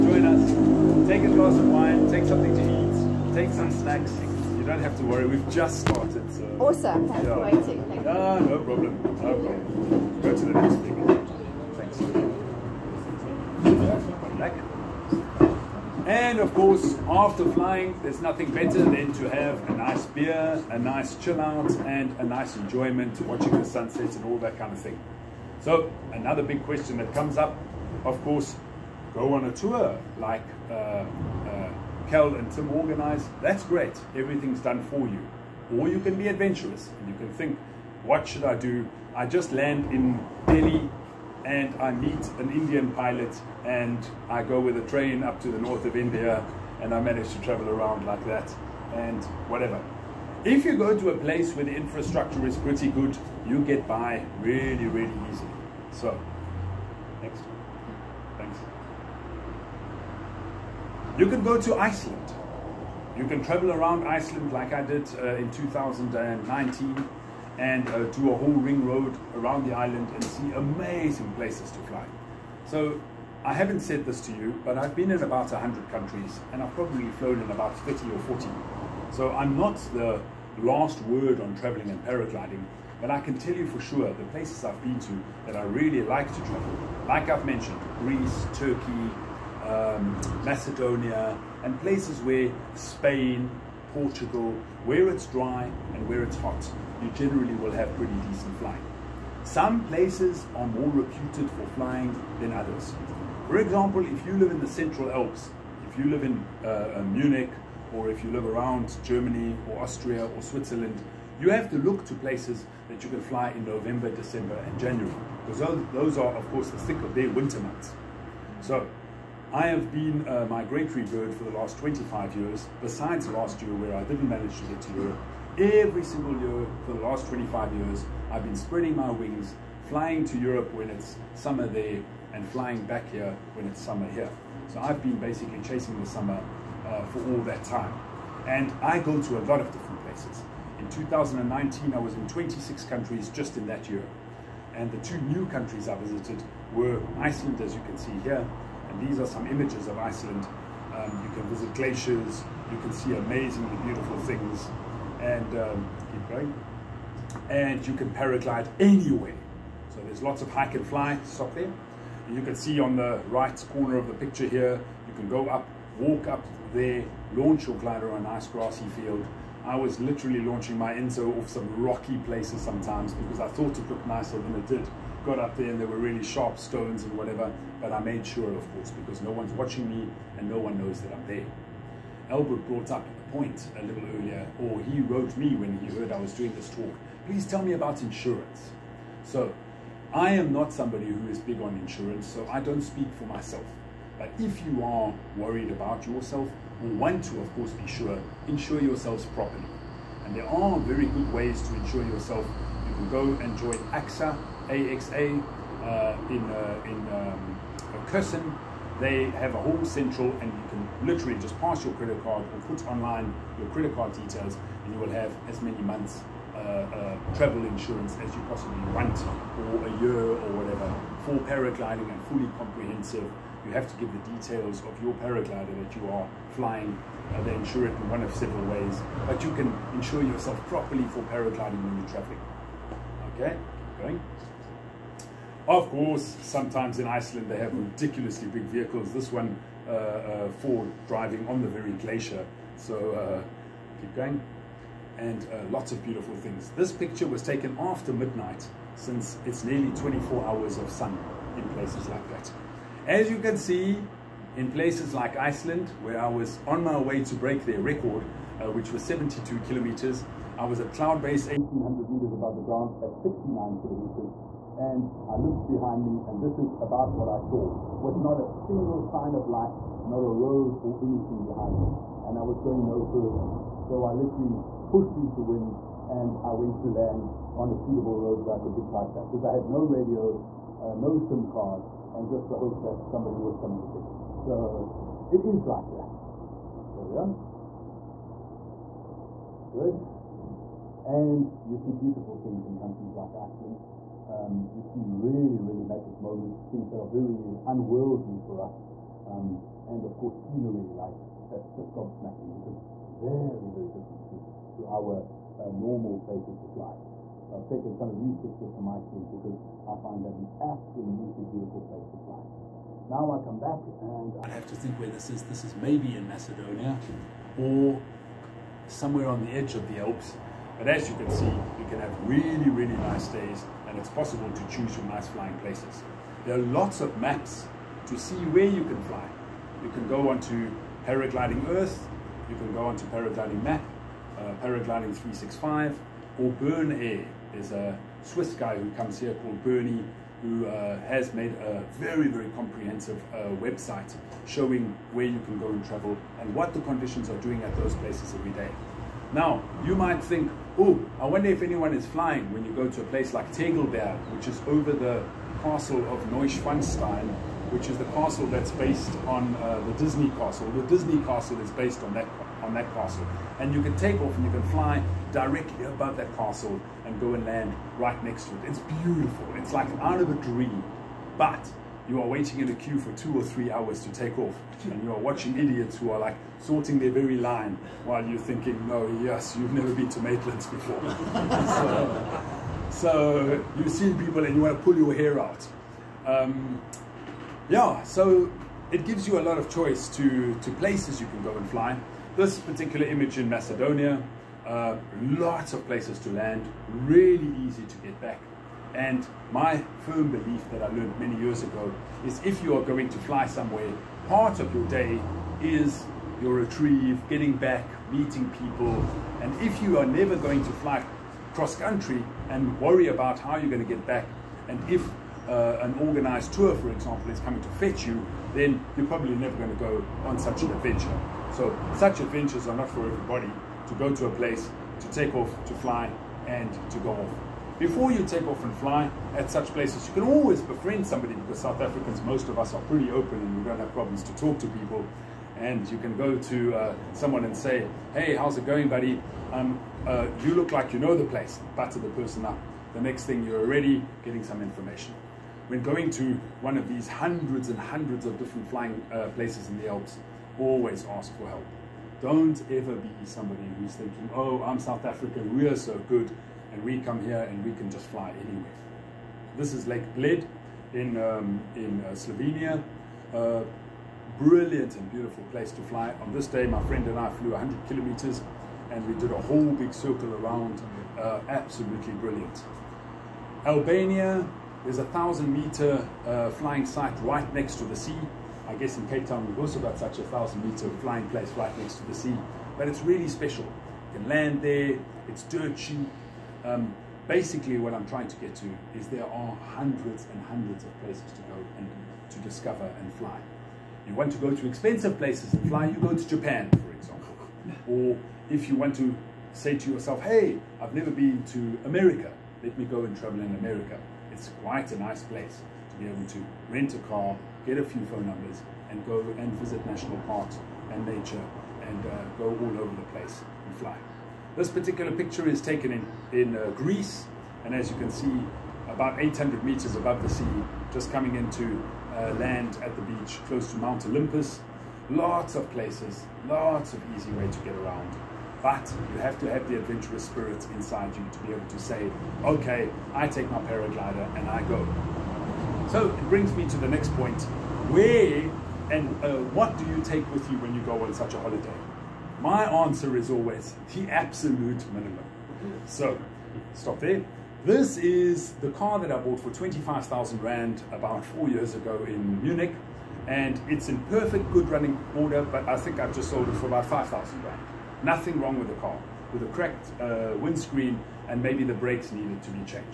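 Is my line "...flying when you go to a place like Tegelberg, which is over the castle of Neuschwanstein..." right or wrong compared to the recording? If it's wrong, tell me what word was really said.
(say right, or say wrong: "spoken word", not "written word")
right.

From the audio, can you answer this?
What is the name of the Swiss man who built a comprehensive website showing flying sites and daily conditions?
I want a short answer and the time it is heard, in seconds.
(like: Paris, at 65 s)
Bernie, at 339 s.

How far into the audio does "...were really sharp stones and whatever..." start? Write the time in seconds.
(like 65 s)
175 s.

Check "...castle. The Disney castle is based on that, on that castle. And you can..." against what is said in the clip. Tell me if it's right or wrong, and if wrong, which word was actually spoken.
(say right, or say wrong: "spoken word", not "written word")
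right.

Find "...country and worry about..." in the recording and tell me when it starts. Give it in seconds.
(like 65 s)
411 s.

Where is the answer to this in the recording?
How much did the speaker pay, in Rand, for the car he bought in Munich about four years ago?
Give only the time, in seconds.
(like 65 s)
549 s.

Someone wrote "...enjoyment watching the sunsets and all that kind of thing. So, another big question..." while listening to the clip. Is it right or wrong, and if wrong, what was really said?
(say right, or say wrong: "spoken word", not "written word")
right.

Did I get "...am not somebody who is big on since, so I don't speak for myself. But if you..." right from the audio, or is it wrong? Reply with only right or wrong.
wrong.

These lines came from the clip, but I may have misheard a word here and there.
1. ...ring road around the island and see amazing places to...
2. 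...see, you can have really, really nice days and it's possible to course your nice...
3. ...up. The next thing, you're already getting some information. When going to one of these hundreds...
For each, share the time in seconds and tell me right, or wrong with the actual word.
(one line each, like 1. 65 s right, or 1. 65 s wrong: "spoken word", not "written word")
1. 68 s right
2. 321 s wrong: "choose", not "course"
3. 442 s right.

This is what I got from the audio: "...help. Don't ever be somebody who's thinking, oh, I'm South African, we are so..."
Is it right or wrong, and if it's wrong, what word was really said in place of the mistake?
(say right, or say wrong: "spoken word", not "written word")
right.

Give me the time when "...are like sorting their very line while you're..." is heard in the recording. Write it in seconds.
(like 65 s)
376 s.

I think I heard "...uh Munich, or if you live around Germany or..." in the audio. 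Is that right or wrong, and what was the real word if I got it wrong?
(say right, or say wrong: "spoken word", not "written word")
right.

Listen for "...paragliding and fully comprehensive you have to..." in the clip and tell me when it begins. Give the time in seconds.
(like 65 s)
221 s.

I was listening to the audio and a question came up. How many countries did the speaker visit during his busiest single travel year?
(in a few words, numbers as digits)
26.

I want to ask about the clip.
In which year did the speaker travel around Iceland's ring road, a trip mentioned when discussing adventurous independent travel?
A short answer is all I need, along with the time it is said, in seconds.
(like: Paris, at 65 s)
2019, at 65 s.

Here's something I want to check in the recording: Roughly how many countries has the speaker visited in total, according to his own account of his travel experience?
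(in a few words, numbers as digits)
100.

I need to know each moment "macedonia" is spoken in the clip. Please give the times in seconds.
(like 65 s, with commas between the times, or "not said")
90 s, 316 s, 393 s.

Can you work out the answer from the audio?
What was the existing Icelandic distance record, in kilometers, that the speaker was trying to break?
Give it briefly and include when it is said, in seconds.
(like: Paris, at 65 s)
72, at 259 s.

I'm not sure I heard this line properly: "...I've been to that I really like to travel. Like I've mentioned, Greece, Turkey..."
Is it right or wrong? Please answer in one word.
right.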